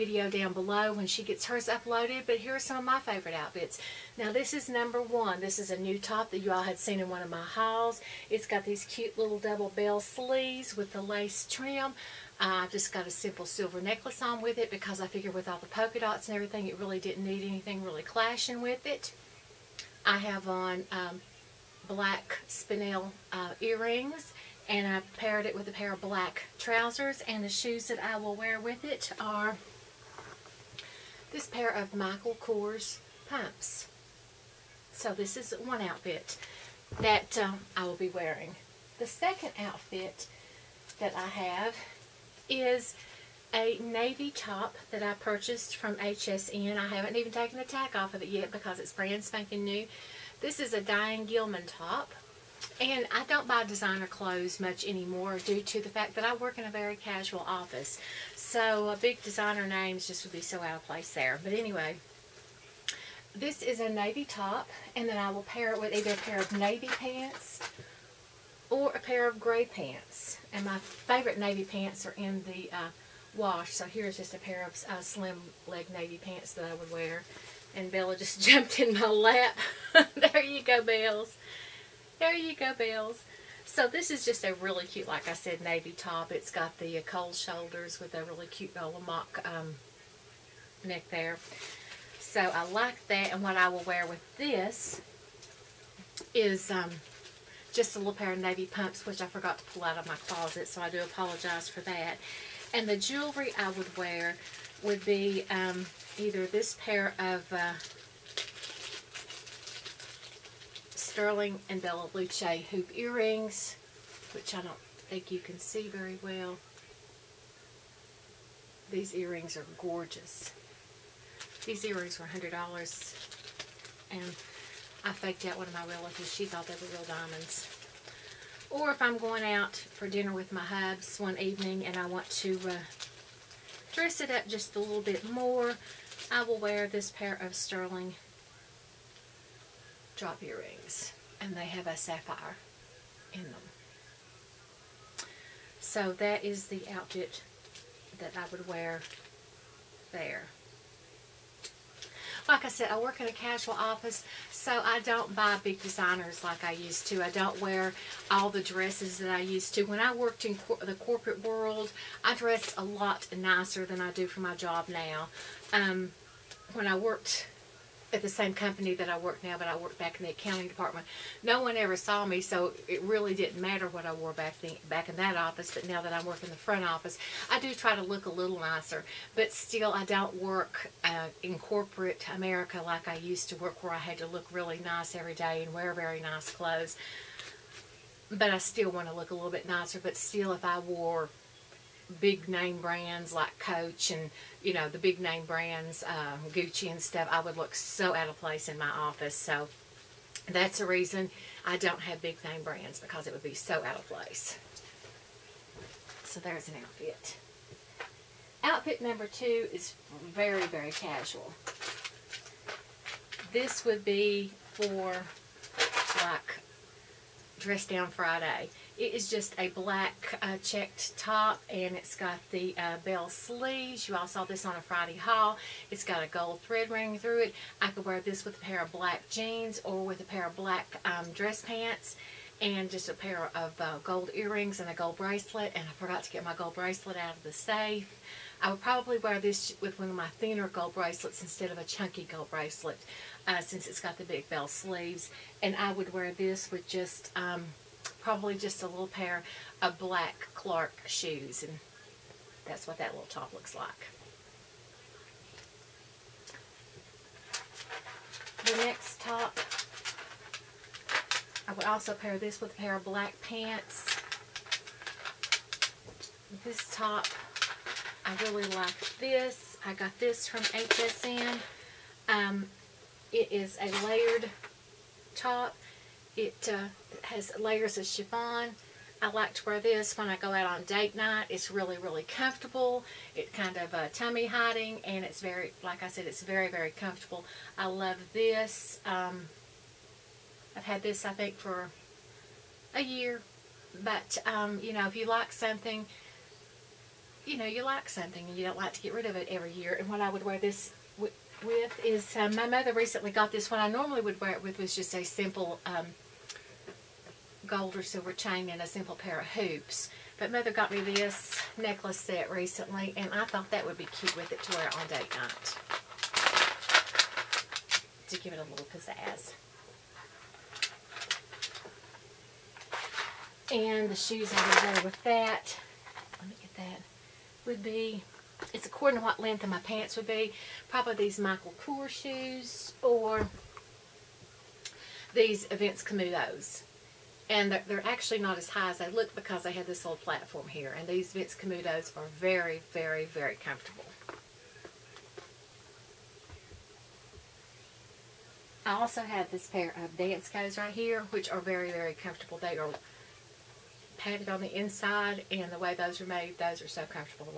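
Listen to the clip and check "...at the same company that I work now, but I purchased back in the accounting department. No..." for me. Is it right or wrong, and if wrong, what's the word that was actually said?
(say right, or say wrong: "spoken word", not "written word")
wrong: "worked", not "purchased".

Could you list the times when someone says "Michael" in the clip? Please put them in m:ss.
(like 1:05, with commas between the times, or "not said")
0:31, 5:31.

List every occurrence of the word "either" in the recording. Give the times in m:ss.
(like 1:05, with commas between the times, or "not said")
1:05, 1:46.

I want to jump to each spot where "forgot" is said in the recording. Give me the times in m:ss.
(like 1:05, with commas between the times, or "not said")
1:39, 3:55.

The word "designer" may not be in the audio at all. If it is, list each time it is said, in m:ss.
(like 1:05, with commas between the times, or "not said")
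0:53, 0:59, 2:35.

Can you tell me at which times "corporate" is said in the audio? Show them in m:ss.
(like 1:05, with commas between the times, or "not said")
2:40, 3:01.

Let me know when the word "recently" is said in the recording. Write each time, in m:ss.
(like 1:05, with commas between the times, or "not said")
5:02, 5:12.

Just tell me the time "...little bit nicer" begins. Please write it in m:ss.
3:09.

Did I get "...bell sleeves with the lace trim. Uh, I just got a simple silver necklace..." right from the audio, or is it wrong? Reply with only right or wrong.
right.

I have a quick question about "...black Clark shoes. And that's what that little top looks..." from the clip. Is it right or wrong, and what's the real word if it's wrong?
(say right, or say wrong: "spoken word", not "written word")
right.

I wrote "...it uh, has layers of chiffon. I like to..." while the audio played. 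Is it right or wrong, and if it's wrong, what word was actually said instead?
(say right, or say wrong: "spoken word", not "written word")
right.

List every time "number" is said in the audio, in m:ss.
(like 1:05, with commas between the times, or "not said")
0:04, 3:29.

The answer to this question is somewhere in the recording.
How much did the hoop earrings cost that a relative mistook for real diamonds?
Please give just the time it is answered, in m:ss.
2:02.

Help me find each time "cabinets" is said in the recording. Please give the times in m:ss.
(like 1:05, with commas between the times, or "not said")
not said.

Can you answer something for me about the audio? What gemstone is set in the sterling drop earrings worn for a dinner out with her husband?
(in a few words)
Sapphire.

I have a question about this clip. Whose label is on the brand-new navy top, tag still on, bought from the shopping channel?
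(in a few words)
Diane Gilman.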